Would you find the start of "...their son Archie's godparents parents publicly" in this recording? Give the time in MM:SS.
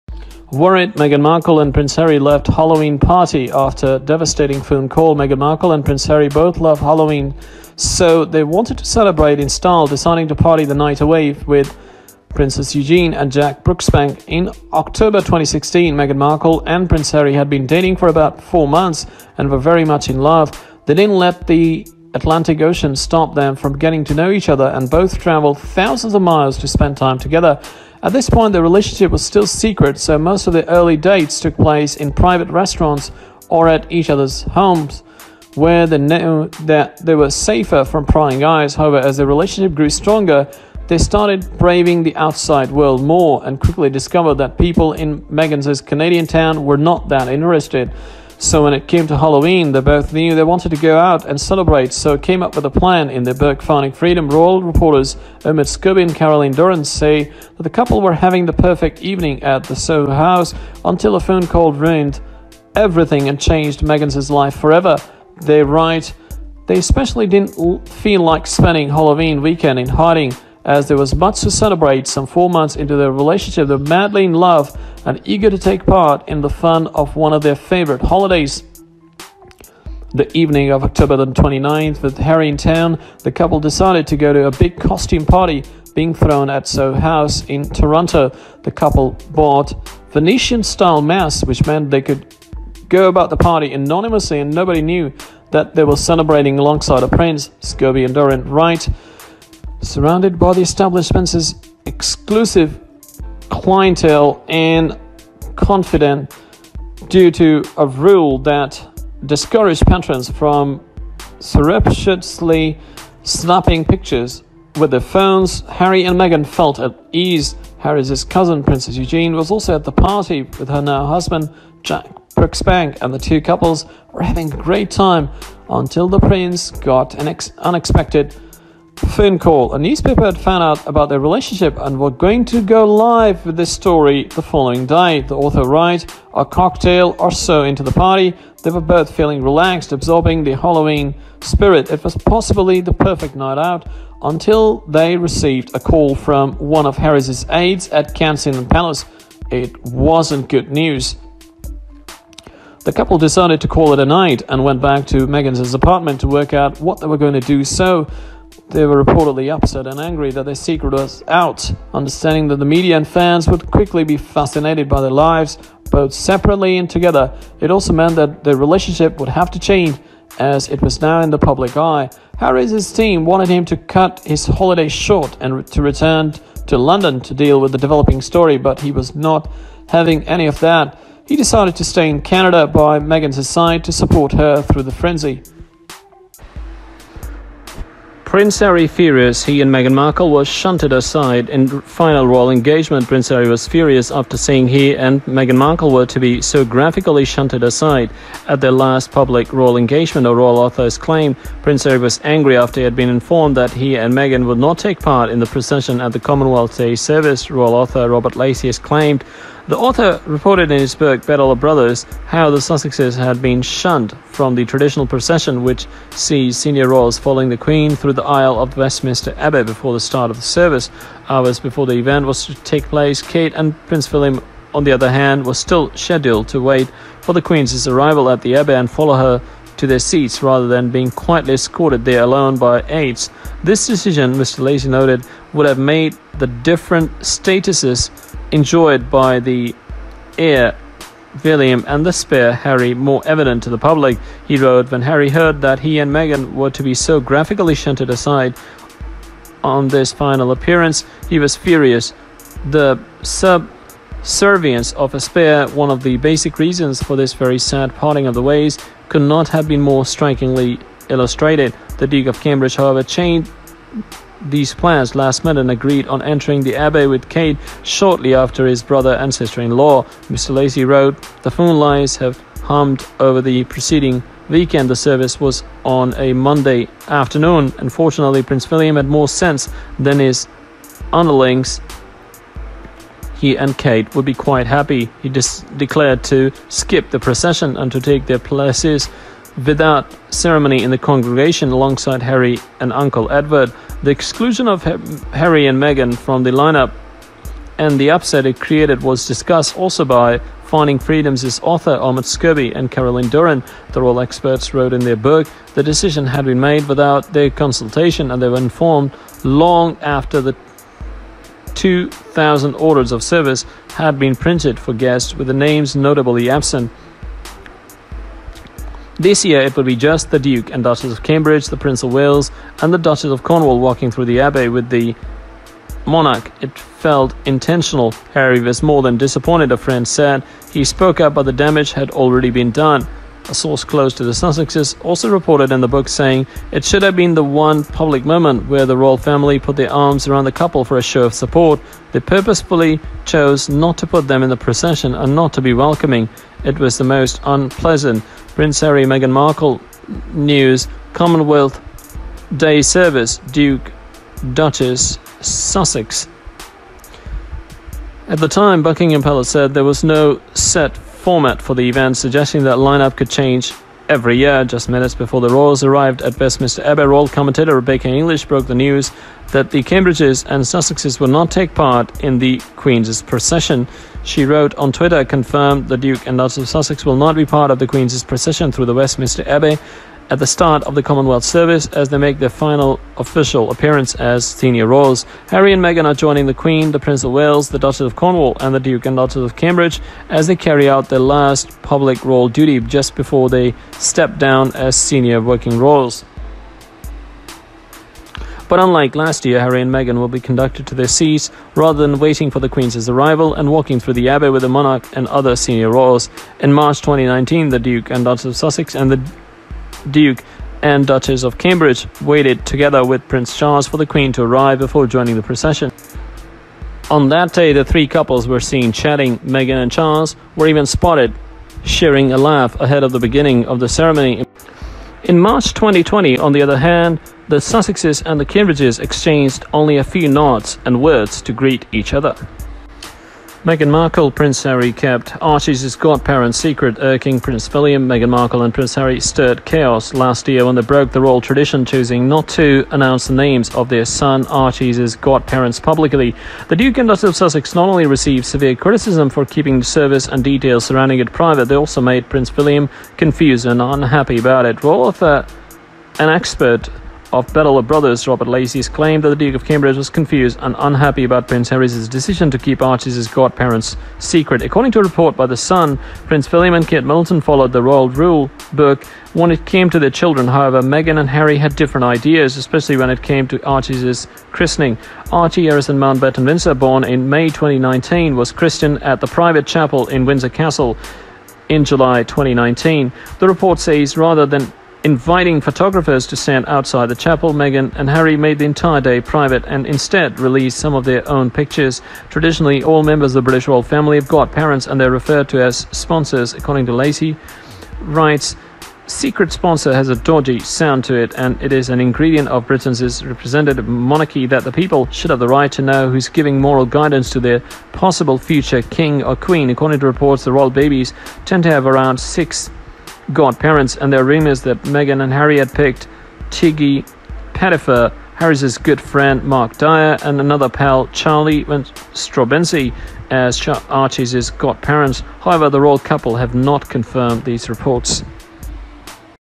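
07:23.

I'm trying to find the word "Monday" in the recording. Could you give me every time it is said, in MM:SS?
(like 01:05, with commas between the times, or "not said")
04:36.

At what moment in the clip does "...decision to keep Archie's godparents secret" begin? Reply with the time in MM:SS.
07:42.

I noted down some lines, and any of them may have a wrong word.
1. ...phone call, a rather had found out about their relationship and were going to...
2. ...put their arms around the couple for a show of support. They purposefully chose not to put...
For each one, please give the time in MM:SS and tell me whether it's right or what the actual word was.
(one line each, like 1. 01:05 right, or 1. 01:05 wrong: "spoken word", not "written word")
1. 02:09 wrong: "newspaper", not "rather"
2. 05:39 right.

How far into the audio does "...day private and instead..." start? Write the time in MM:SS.
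08:09.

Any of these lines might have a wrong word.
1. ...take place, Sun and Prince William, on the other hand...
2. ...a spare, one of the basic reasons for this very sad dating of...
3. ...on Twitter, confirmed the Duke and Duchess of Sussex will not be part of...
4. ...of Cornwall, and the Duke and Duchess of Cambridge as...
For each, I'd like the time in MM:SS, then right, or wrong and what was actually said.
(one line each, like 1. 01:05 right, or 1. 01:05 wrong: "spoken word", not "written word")
1. 03:42 wrong: "Kate", not "Sun"
2. 04:15 wrong: "parting", not "dating"
3. 06:14 right
4. 06:27 right.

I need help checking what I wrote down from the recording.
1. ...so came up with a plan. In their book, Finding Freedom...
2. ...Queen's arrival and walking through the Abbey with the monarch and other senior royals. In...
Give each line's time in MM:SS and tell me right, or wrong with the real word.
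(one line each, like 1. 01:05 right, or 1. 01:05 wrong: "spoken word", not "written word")
1. 00:51 right
2. 06:42 right.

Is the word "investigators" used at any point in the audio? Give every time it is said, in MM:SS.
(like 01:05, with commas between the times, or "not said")
not said.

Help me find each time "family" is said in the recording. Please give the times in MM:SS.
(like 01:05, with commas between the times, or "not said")
05:39, 08:13.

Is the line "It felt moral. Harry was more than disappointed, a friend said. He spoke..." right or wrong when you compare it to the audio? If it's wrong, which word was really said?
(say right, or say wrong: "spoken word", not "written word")
wrong: "intentional", not "moral".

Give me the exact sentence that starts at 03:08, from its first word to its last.
Prince Harry furious, he and Meghan Markle were shunted aside in final royal engagement.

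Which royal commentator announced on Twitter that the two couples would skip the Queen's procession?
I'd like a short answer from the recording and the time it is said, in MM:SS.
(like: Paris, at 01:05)
Rebecca English, at 06:07.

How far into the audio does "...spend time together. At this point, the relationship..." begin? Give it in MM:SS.
00:26.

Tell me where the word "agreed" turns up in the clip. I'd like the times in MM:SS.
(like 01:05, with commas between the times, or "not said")
04:25.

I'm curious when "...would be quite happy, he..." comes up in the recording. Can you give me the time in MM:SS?
04:44.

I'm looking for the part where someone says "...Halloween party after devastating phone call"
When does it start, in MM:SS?
00:02.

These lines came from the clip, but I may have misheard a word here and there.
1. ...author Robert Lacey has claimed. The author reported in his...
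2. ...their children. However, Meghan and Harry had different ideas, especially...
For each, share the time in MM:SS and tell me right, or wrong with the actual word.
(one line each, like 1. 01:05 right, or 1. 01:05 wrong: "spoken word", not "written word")
1. 03:27 right
2. 07:49 right.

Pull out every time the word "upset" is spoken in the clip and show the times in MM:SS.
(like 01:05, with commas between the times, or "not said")
02:39, 04:58.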